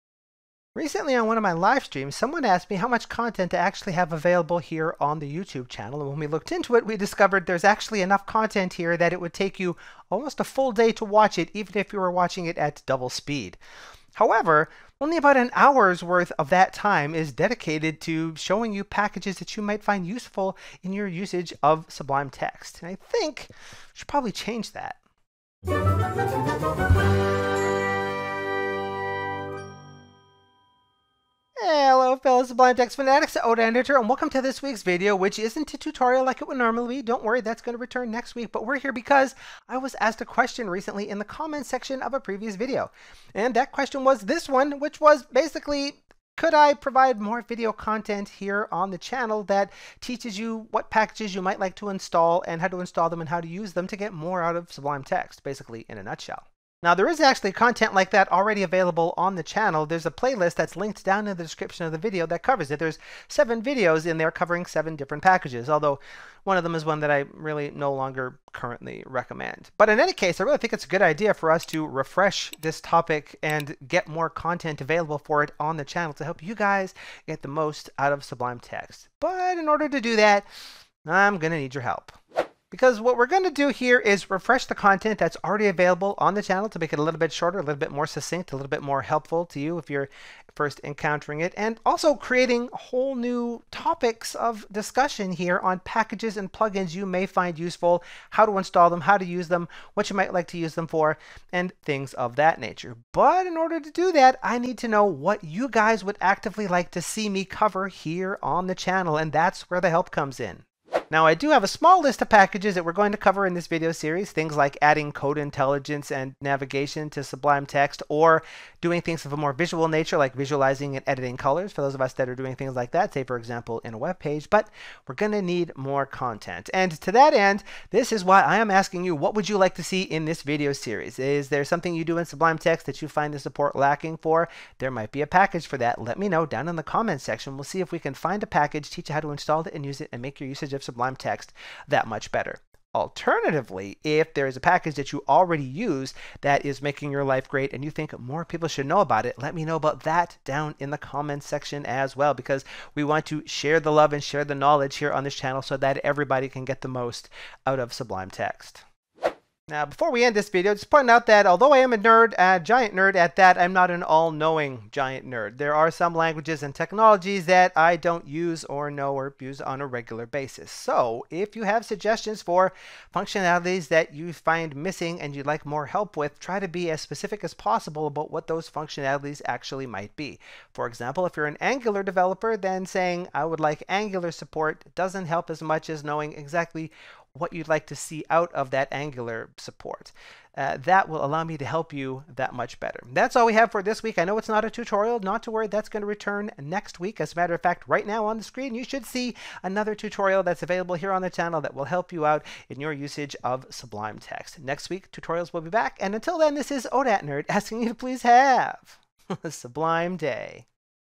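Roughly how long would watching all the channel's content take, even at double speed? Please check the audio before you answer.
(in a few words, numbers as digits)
Almost a full day.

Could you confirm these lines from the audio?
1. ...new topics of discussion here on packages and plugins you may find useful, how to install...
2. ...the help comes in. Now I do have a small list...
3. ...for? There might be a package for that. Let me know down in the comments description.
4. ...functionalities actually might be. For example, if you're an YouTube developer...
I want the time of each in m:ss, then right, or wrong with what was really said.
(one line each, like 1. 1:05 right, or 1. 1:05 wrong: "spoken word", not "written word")
1. 1:33 right
2. 1:49 right
3. 2:14 wrong: "section", not "description"
4. 2:58 wrong: "Angular", not "YouTube".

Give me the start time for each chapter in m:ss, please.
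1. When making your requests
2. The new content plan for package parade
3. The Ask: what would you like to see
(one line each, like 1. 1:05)
1. 2:39
2. 1:22
3. 1:50.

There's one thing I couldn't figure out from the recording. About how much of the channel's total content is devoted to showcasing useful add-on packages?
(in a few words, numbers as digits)
About an hour.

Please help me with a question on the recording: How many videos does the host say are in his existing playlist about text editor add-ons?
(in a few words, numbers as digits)
7.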